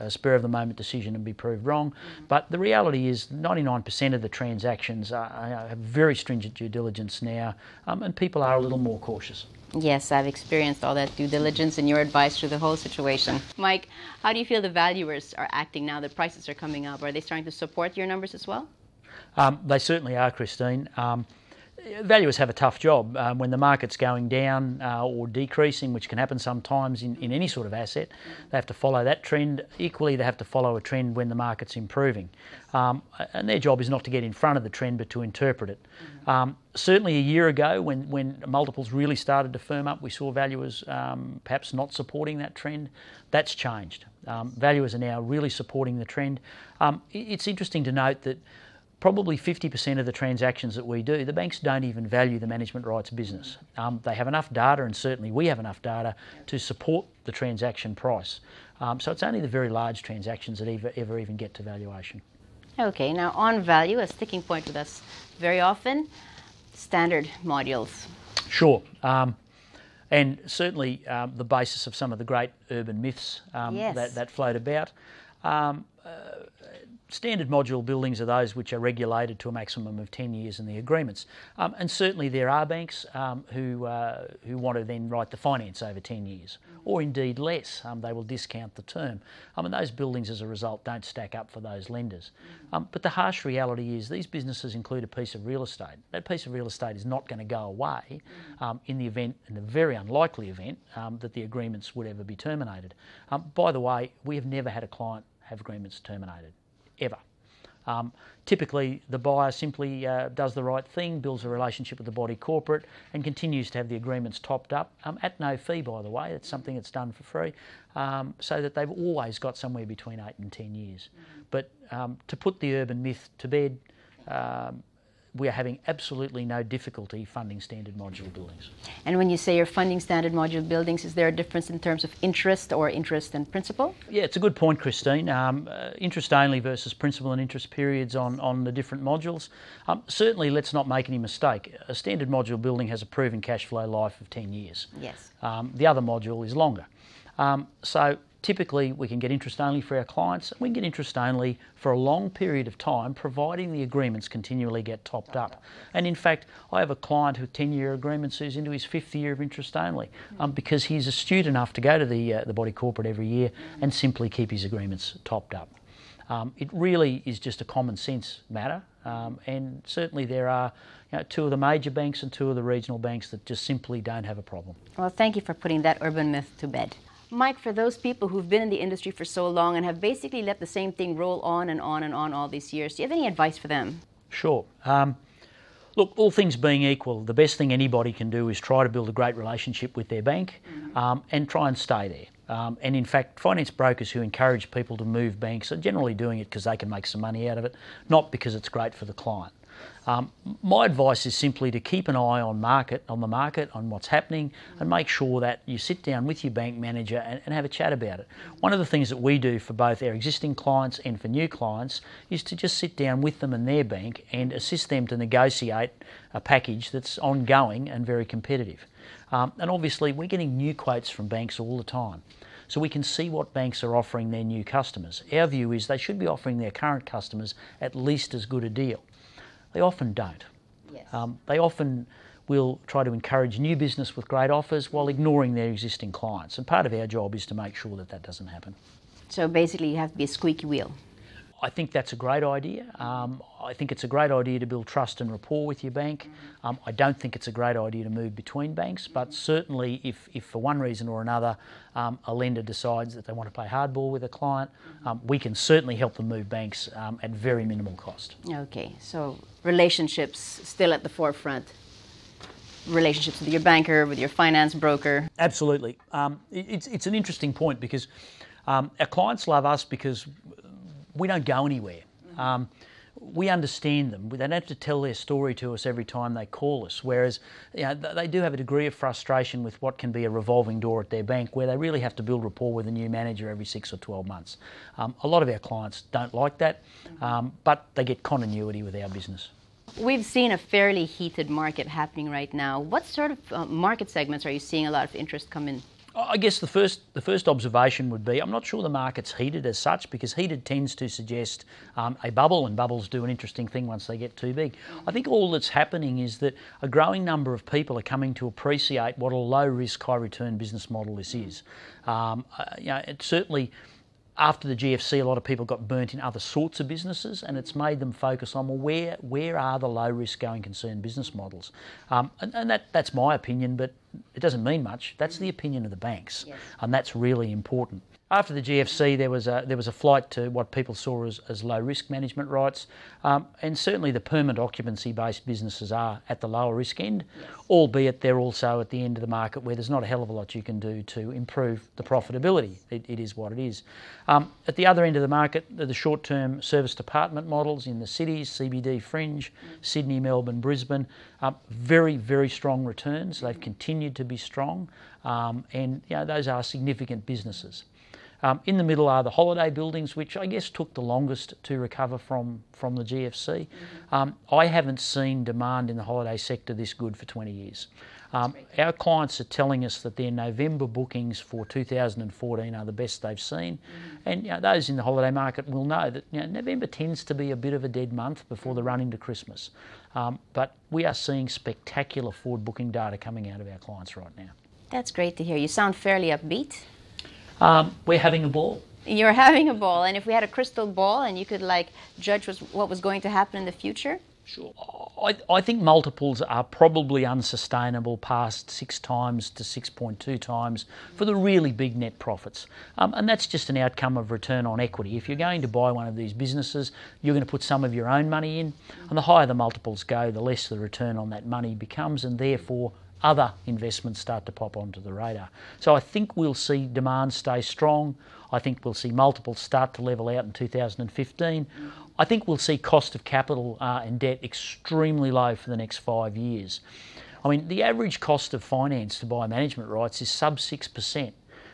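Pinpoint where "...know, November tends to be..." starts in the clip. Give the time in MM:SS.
06:16.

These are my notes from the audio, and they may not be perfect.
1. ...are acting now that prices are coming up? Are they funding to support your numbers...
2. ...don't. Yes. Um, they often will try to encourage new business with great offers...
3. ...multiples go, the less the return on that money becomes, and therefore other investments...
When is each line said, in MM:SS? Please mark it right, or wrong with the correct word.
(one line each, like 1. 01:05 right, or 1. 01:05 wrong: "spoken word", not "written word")
1. 00:15 wrong: "starting", not "funding"
2. 03:50 right
3. 06:49 right.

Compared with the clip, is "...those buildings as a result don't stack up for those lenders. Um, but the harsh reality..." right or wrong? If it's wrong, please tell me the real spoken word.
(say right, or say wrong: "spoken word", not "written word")
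right.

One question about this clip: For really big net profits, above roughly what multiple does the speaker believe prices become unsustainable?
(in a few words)
6.2 times.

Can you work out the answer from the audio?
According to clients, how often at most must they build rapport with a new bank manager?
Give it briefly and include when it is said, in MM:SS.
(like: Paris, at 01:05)
every 6 or 12 months, at 04:43.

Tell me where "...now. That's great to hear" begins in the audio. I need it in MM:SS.
06:24.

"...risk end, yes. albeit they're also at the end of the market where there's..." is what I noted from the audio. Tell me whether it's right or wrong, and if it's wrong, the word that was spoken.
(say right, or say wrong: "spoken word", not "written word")
right.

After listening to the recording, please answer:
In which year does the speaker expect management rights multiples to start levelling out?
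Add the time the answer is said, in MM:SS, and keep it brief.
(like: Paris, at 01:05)
2015, at 07:00.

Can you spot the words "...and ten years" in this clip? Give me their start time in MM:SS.
02:00.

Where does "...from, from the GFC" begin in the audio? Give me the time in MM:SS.
06:02.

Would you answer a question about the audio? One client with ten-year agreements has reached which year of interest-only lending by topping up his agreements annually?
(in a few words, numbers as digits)
fifth year.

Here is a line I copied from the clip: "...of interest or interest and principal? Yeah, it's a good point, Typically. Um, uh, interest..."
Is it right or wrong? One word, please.
wrong.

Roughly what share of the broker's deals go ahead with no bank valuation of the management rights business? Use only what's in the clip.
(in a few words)
50%.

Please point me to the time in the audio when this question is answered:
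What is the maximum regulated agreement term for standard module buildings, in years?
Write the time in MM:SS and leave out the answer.
01:19.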